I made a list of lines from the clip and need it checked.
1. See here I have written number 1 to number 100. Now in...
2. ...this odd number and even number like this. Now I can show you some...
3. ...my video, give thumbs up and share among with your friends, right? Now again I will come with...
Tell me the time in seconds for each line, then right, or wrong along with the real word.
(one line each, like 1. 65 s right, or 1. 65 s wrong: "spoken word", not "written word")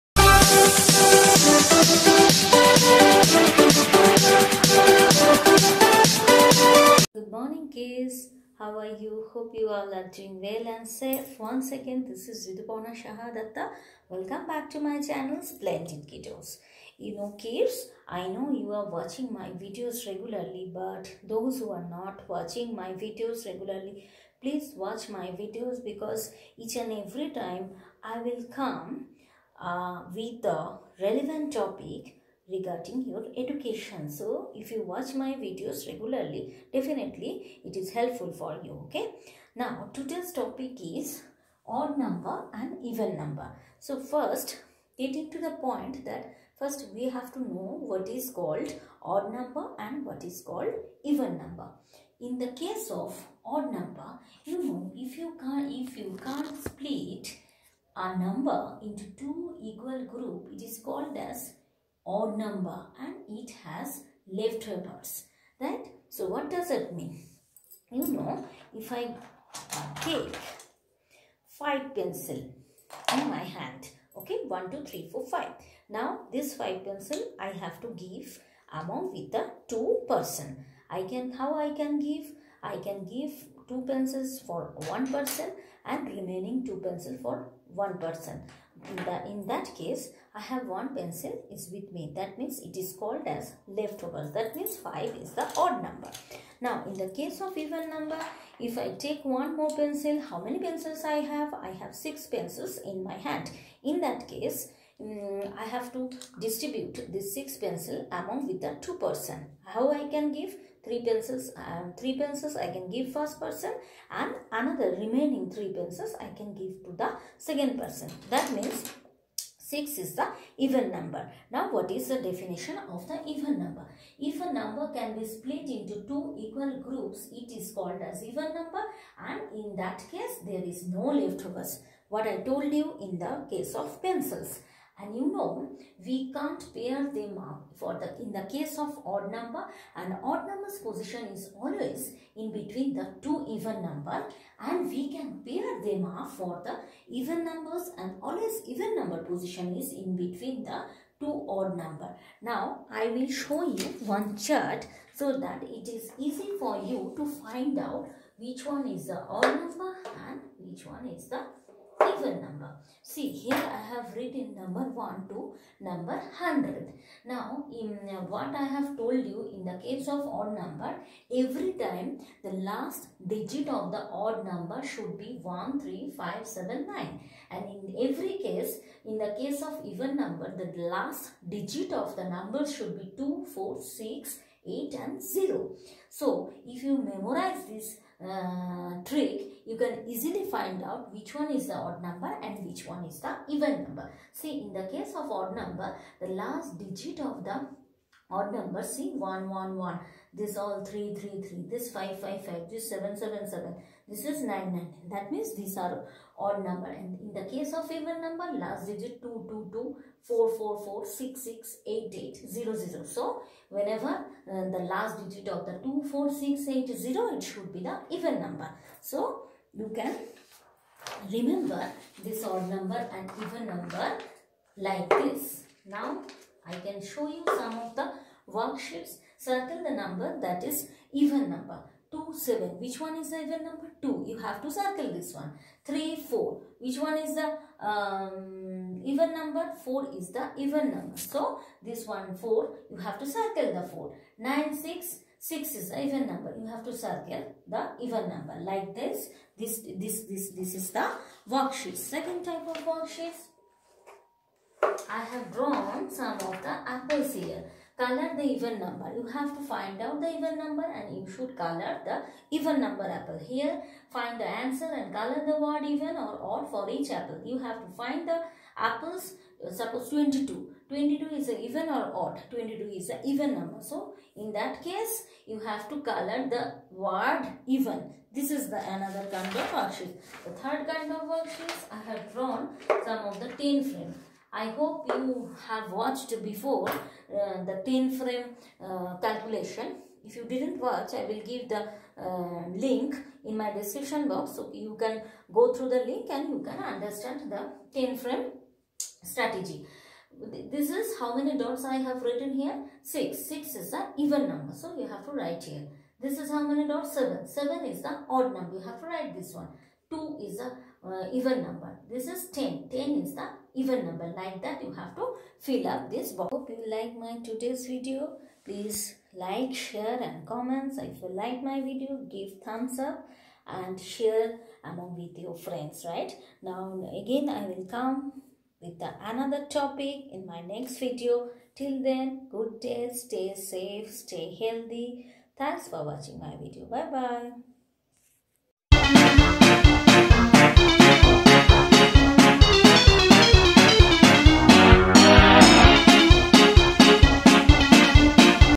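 1. 163 s right
2. 222 s right
3. 321 s right.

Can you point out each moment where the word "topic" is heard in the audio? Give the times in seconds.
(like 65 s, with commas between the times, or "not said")
31 s, 40 s, 329 s.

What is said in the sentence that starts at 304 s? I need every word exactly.
So you have to write here.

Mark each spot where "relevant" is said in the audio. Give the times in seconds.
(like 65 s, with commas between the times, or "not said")
31 s.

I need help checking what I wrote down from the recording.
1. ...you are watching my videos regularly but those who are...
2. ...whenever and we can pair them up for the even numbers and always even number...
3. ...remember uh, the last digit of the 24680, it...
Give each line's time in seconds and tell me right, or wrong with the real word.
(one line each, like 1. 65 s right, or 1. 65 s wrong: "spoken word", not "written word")
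1. 18 s right
2. 143 s wrong: "number", not "whenever"
3. 213 s wrong: "whenever", not "remember".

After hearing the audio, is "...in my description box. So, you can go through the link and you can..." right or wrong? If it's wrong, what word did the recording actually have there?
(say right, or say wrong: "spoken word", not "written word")
right.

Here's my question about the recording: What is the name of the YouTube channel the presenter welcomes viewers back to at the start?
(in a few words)
Splendid Kiddos.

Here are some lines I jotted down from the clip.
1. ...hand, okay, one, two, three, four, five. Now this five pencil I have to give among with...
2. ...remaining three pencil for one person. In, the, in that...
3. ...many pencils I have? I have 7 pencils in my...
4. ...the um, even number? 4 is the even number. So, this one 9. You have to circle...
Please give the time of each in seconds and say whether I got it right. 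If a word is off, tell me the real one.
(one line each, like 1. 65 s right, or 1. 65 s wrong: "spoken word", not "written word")
1. 73 s right
2. 86 s wrong: "two", not "three"
3. 100 s wrong: "6", not "7"
4. 237 s wrong: "4", not "9".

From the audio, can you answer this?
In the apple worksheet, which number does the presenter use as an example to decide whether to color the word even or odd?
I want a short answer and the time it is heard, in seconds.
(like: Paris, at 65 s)
22, at 269 s.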